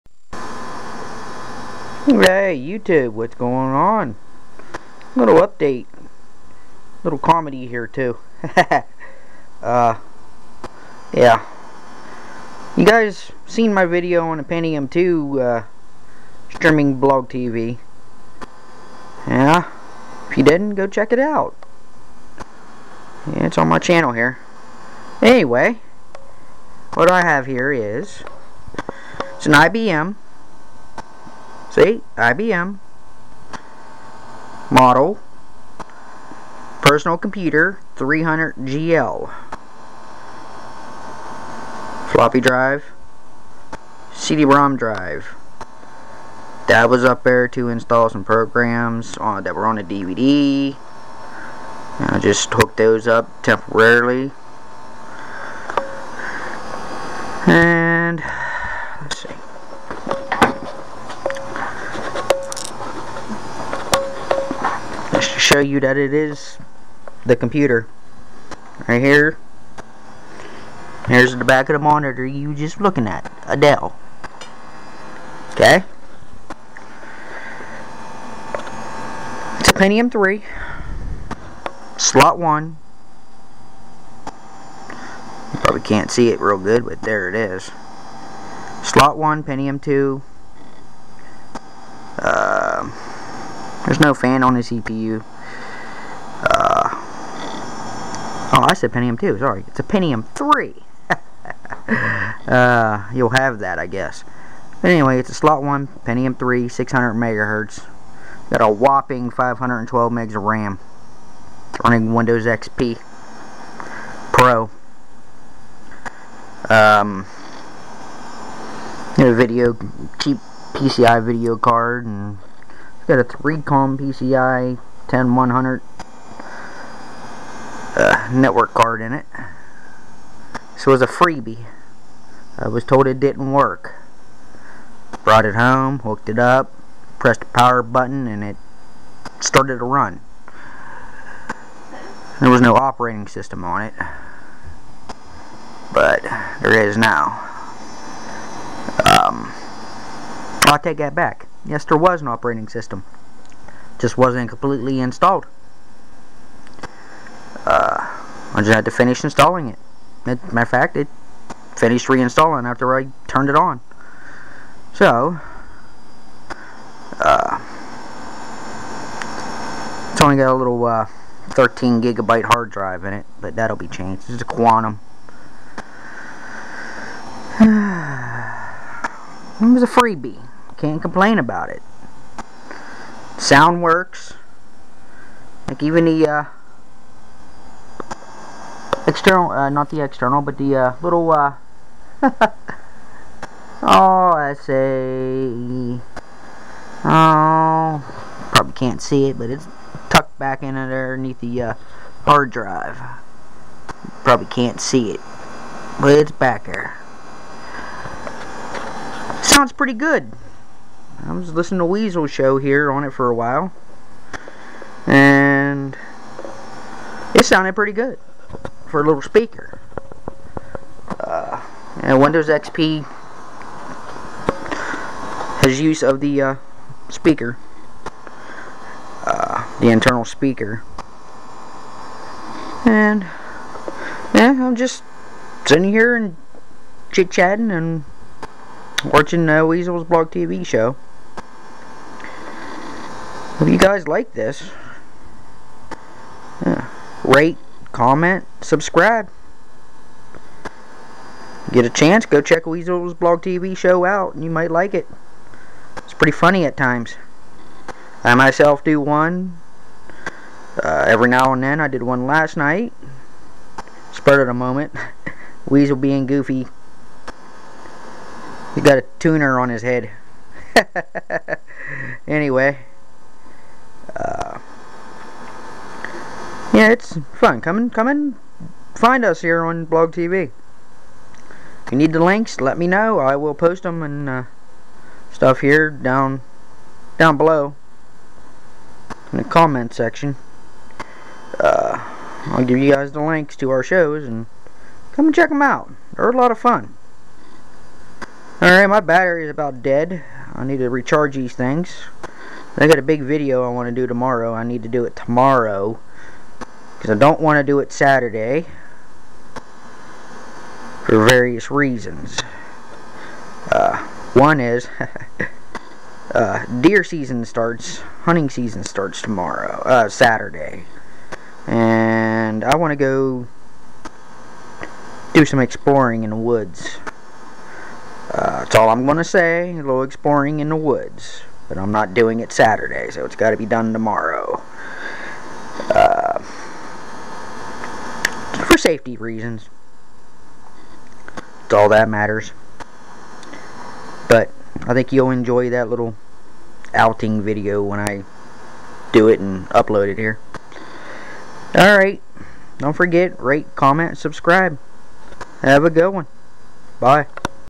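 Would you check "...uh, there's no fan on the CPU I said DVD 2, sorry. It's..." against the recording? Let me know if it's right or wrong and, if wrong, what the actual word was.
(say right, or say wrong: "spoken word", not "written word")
wrong: "Pentium", not "DVD".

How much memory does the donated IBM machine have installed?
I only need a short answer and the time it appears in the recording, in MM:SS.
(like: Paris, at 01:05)
512 megs, at 01:49.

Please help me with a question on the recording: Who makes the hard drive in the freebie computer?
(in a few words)
Quantum.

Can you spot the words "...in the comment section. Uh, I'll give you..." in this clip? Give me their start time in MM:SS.
04:49.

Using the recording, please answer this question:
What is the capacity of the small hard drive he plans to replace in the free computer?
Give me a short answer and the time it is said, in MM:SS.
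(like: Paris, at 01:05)
13 gigabytes, at 02:51.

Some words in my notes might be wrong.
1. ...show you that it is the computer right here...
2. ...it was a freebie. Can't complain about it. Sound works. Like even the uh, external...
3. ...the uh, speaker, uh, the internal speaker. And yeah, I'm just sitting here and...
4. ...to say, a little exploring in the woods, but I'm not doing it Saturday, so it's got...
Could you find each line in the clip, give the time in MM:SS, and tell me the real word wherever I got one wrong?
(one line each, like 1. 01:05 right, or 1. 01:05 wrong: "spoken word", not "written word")
1. 01:05 right
2. 02:57 right
3. 03:46 right
4. 05:29 right.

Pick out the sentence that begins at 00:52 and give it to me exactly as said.
And I just hooked those up temporarily.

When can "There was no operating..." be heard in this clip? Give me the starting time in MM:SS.
02:22.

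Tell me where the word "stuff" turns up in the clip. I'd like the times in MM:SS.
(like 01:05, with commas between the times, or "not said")
04:45.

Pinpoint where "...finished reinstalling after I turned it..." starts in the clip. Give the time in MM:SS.
02:41.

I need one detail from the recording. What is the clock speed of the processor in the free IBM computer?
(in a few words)
600 megahertz.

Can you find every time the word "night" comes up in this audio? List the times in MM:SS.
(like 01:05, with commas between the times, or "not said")
04:22.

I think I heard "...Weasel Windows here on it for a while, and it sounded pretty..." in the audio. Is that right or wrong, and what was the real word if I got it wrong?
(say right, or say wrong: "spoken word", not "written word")
wrong: "Show", not "Windows".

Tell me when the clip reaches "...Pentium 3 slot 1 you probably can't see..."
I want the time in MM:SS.
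01:19.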